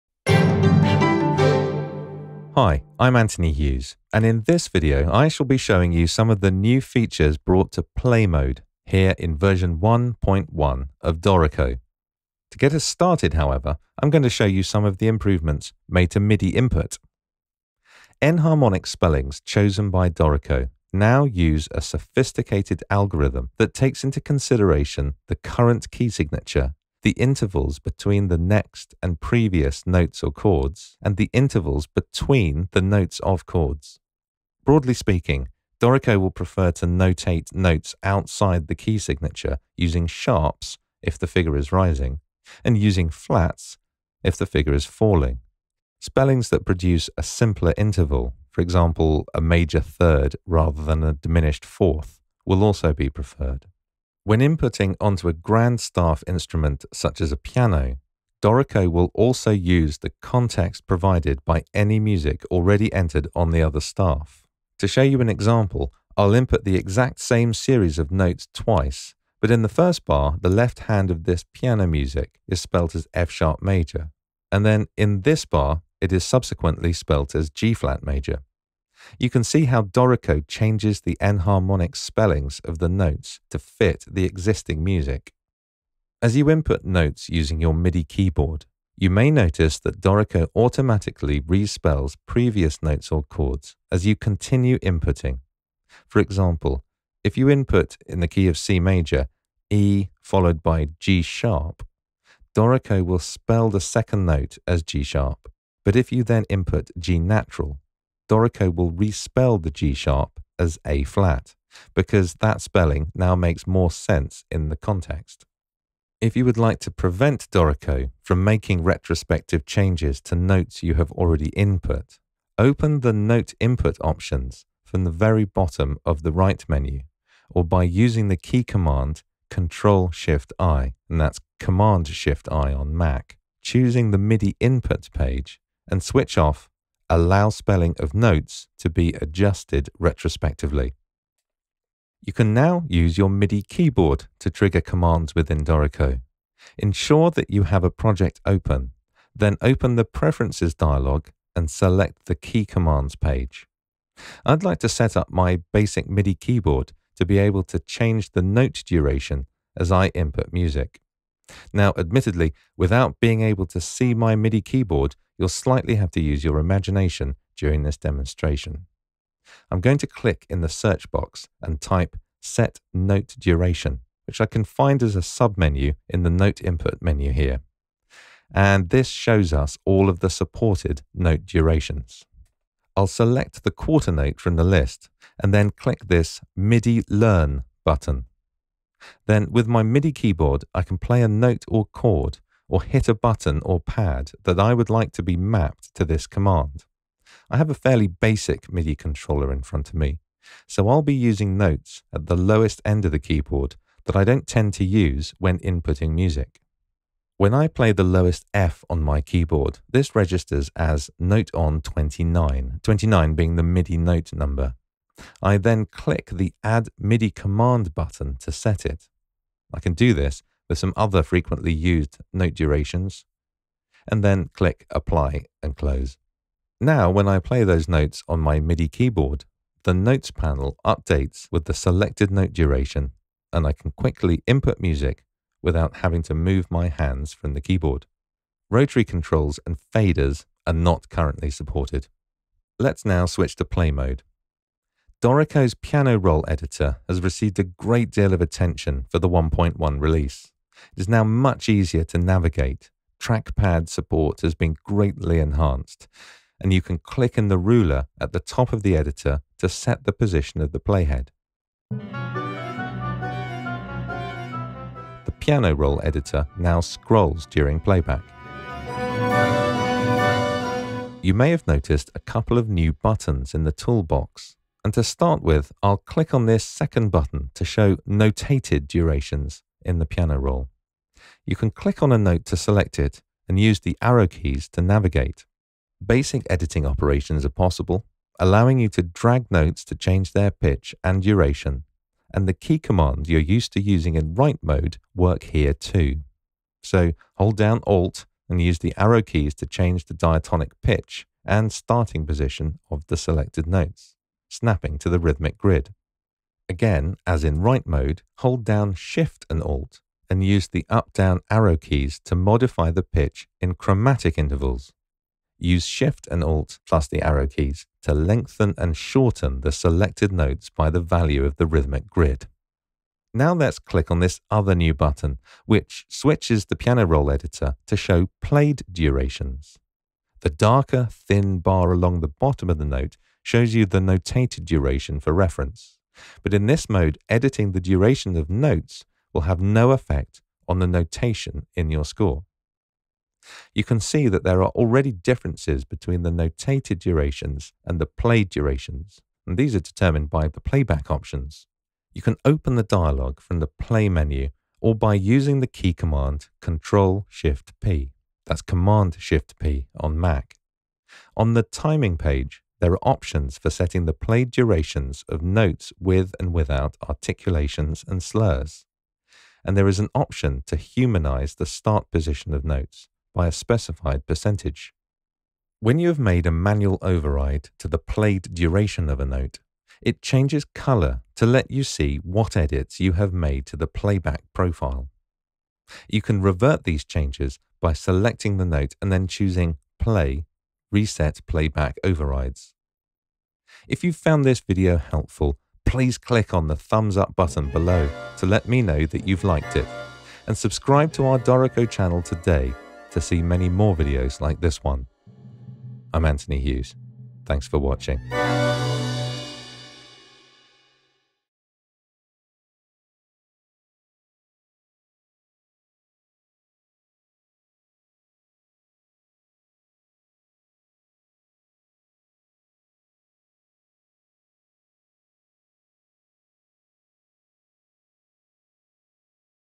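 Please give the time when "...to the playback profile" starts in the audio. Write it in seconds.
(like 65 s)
383 s.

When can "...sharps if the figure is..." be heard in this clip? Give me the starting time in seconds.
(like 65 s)
40 s.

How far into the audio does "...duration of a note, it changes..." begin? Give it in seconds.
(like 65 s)
378 s.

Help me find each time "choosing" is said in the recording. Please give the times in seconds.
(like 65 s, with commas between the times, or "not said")
133 s, 389 s.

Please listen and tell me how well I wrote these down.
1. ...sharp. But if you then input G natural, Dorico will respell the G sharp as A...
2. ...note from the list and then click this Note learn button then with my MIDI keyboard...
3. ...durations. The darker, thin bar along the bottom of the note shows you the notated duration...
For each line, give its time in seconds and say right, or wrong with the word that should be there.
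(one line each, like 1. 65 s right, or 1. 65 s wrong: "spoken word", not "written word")
1. 105 s right
2. 184 s wrong: "MIDI", not "Note"
3. 328 s right.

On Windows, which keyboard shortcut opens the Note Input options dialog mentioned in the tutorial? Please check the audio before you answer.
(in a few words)
Control Shift I.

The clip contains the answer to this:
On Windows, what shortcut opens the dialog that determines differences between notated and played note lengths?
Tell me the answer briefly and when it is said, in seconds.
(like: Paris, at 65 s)
Control Shift P, at 356 s.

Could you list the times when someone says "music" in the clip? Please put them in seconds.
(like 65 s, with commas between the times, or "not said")
61 s, 71 s, 84 s, 160 s, 206 s, 234 s.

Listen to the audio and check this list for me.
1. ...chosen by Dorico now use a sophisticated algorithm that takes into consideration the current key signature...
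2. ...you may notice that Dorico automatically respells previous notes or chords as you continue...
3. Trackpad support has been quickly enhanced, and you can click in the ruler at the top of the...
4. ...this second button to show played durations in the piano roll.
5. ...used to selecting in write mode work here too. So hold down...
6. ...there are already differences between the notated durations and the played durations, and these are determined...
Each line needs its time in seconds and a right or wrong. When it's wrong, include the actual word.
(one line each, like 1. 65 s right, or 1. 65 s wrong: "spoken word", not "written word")
1. 19 s right
2. 88 s right
3. 253 s wrong: "greatly", not "quickly"
4. 276 s wrong: "notated", not "played"
5. 293 s wrong: "using", not "selecting"
6. 344 s right.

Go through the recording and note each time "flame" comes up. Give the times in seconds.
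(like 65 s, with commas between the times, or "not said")
not said.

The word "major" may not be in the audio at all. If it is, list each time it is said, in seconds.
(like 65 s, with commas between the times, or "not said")
49 s, 73 s, 78 s, 98 s.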